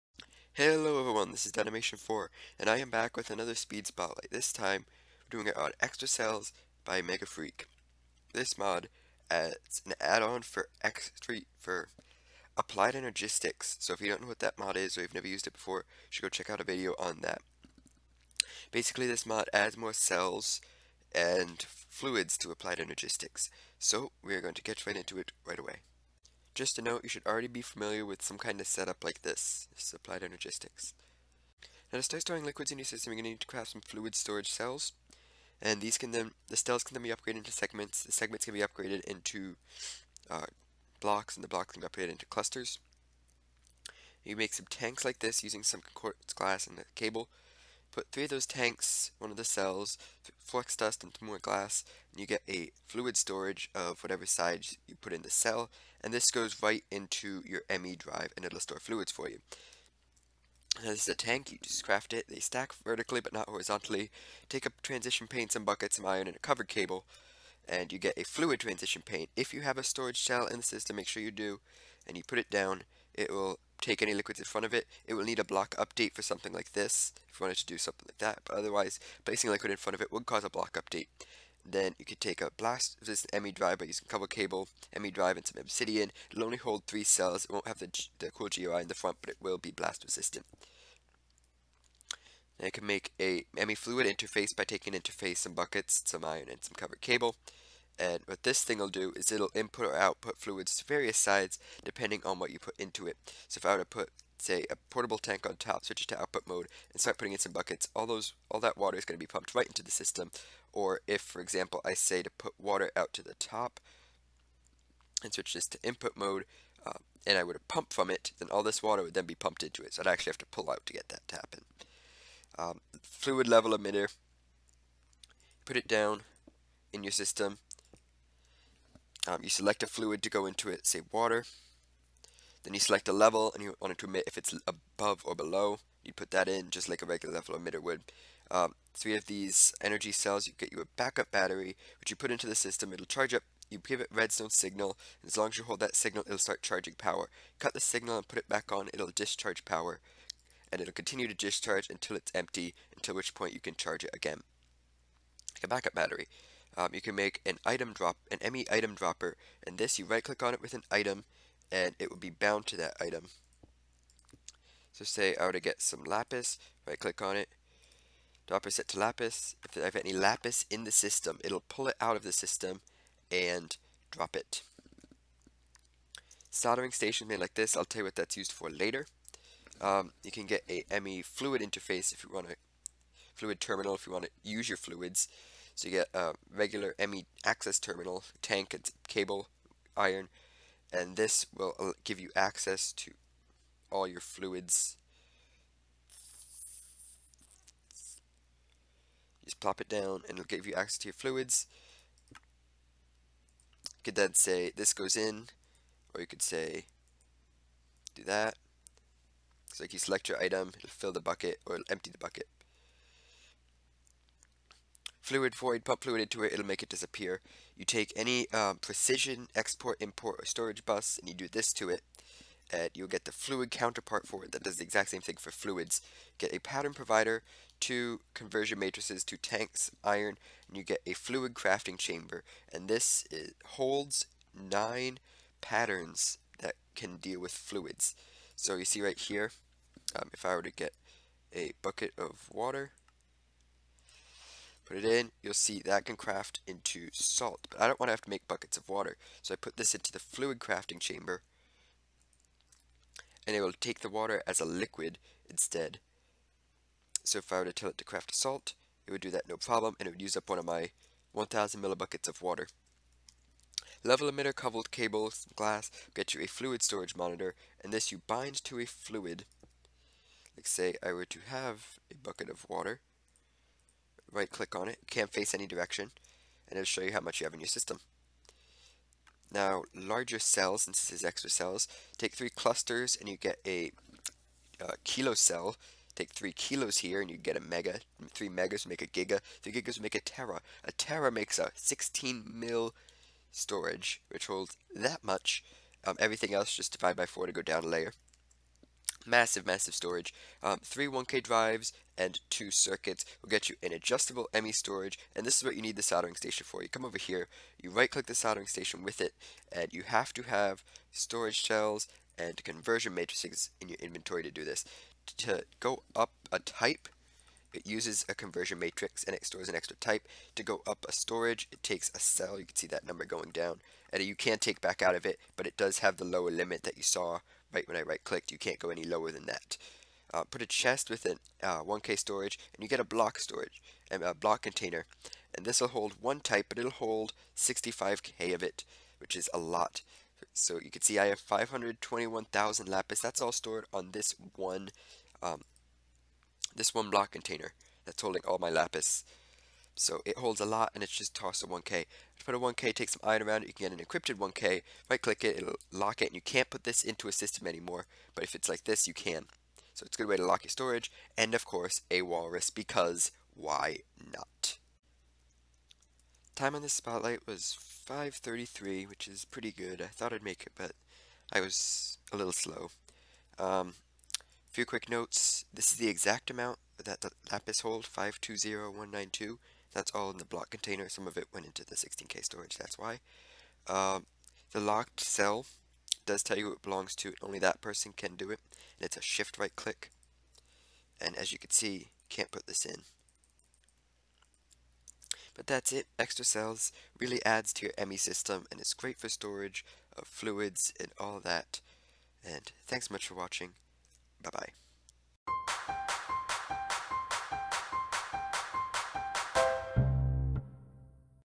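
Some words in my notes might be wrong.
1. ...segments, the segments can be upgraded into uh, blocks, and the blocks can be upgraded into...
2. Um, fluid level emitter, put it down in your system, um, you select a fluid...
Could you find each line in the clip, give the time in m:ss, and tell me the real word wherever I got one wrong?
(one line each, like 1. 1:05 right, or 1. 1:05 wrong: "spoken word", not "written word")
1. 0:37 right
2. 2:02 right.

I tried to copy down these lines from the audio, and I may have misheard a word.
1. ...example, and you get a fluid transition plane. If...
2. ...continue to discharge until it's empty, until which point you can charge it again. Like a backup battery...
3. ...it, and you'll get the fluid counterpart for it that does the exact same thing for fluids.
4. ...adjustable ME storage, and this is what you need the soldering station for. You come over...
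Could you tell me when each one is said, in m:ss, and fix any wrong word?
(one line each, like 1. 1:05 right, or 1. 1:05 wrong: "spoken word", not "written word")
1. 1:06 wrong: "cable", not "example"
2. 2:30 right
3. 3:41 right
4. 5:03 right.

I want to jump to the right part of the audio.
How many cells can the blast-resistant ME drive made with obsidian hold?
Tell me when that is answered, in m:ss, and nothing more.
1:26.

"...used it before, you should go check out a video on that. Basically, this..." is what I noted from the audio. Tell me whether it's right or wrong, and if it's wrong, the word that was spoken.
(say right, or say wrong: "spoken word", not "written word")
right.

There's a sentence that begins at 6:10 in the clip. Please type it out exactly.
I thought I'd make it, but I was a little slow.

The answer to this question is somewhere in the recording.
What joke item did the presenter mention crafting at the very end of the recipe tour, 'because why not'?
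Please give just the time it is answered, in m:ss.
6:02.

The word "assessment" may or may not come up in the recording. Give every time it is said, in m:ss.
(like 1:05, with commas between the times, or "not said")
not said.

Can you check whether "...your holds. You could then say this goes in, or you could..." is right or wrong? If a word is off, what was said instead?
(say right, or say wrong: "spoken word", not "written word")
wrong: "fluids", not "holds".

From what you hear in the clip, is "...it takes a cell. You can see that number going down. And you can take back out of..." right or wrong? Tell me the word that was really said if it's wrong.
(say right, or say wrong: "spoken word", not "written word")
right.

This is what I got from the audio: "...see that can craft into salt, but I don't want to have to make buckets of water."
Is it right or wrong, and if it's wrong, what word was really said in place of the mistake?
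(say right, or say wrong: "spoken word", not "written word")
right.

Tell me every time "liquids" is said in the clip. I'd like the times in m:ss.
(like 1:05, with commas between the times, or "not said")
0:32, 1:14, 1:19, 4:14.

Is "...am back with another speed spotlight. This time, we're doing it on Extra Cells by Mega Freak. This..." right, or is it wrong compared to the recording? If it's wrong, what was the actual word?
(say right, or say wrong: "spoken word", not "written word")
right.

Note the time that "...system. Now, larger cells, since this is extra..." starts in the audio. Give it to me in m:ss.
4:37.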